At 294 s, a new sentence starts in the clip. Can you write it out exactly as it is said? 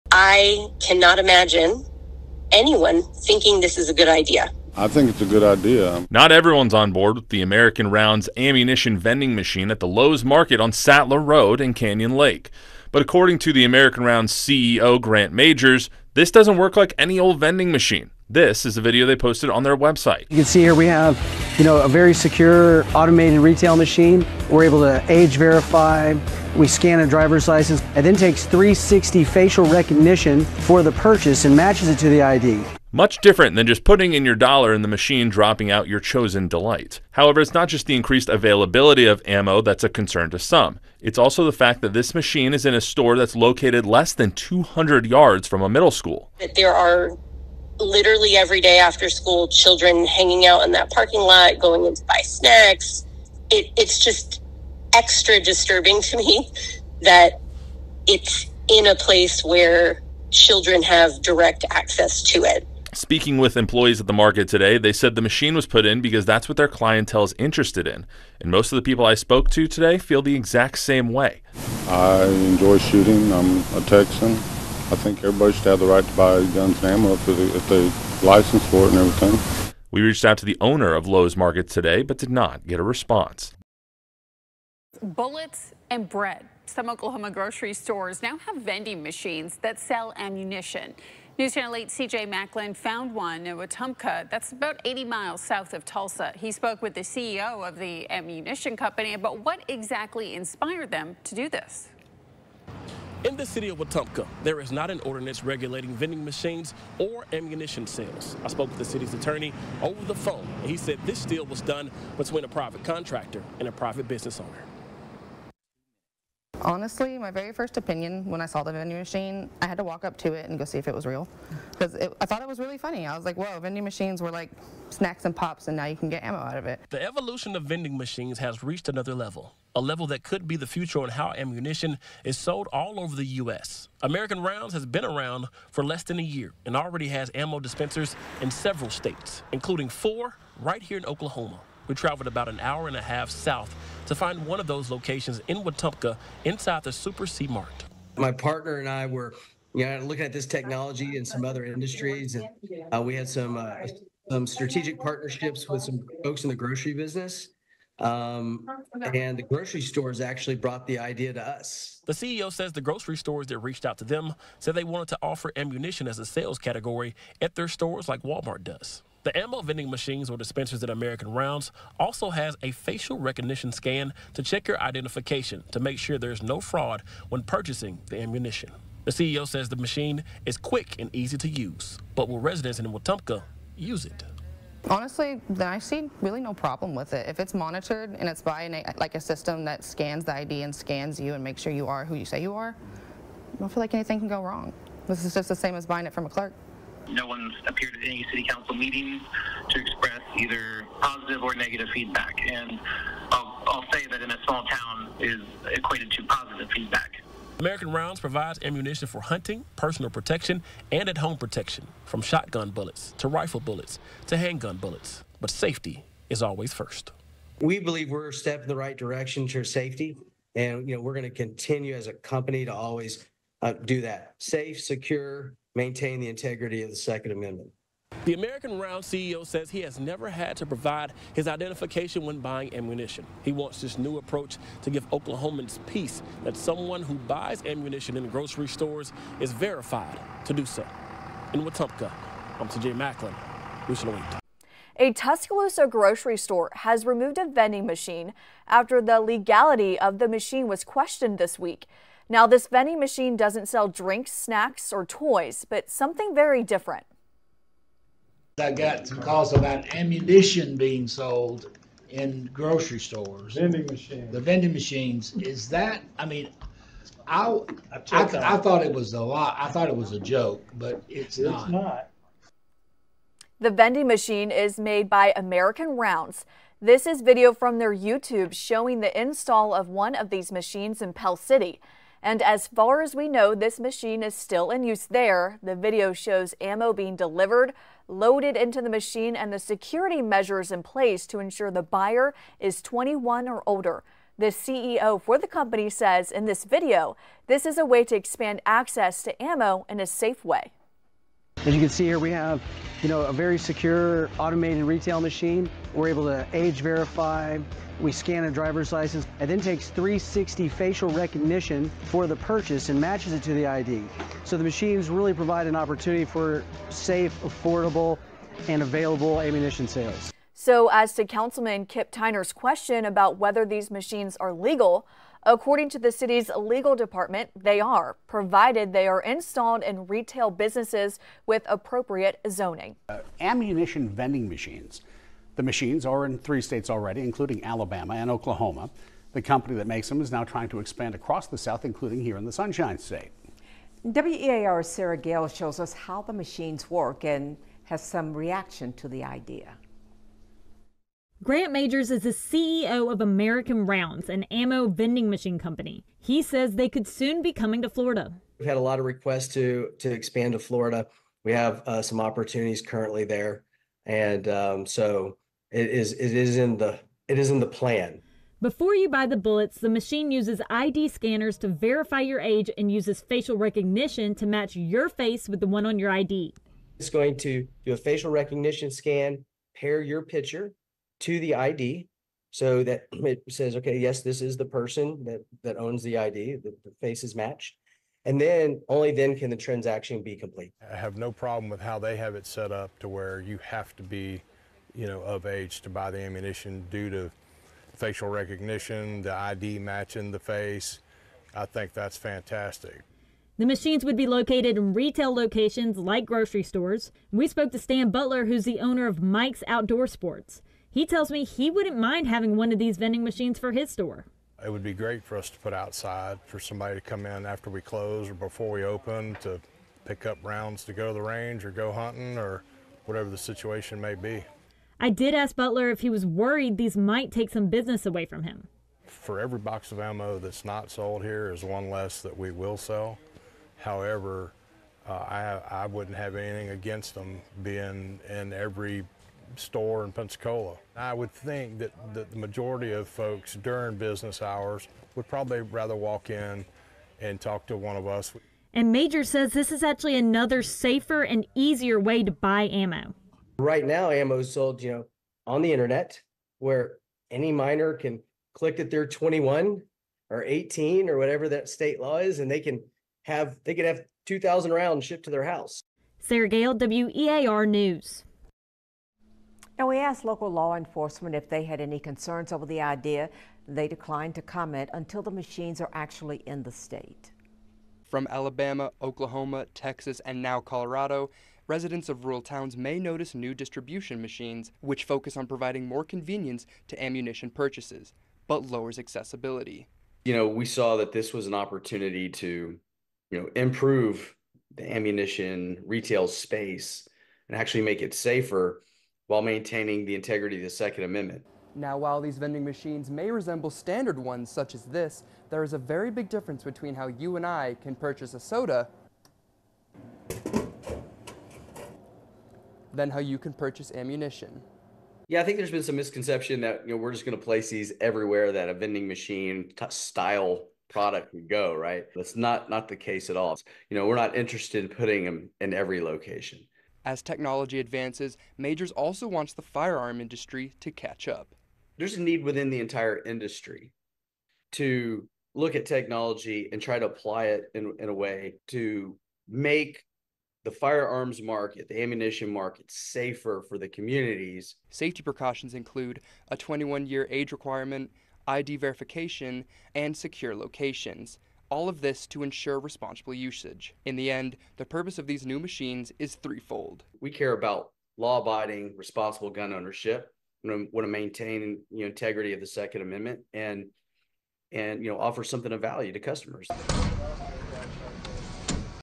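The CEO for the company says in this video, this is a way to expand access to ammo in a safe way.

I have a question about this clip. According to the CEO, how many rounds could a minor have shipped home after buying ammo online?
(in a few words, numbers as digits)
2,000.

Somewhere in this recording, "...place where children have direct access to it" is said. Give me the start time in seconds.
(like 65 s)
58 s.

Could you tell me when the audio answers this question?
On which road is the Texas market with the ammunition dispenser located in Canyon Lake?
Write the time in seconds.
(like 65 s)
10 s.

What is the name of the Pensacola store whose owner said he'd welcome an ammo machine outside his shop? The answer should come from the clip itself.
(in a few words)
Mike's Outdoor Sports.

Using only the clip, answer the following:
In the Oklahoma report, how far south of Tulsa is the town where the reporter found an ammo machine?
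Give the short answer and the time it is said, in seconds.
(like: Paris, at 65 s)
80 miles, at 94 s.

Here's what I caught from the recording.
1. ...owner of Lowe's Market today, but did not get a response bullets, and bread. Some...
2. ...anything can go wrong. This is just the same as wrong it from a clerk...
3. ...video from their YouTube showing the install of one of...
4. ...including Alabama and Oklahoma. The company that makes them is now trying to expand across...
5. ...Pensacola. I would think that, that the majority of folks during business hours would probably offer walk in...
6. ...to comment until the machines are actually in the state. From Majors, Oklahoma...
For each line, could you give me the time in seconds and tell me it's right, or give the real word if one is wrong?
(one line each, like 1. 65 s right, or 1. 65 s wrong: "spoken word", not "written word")
1. 80 s right
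2. 193 s wrong: "buying", not "wrong"
3. 277 s right
4. 337 s right
5. 440 s wrong: "rather", not "offer"
6. 474 s wrong: "Alabama", not "Majors".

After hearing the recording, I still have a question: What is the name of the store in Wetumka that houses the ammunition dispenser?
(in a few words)
Super C Mart.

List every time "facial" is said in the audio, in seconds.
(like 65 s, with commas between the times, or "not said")
29 s, 172 s, 310 s, 373 s, 377 s, 397 s.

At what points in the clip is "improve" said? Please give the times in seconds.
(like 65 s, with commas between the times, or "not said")
493 s.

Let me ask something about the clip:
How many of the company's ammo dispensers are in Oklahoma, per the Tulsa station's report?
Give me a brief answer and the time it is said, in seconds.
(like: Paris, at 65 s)
4, at 139 s.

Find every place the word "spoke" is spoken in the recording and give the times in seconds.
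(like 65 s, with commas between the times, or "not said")
69 s, 96 s, 108 s, 407 s.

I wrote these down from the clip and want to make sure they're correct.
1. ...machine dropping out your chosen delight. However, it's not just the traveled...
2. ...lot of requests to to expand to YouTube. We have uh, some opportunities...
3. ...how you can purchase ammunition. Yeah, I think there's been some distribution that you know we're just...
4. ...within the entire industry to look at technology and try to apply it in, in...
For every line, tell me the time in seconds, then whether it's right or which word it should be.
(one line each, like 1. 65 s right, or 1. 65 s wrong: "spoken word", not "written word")
1. 34 s wrong: "increased", not "traveled"
2. 358 s wrong: "Florida", not "YouTube"
3. 513 s wrong: "misconception", not "distribution"
4. 532 s right.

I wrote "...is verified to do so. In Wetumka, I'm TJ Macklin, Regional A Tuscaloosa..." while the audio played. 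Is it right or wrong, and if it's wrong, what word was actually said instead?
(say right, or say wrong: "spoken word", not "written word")
right.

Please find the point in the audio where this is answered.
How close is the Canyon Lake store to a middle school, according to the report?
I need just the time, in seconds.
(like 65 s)
44 s.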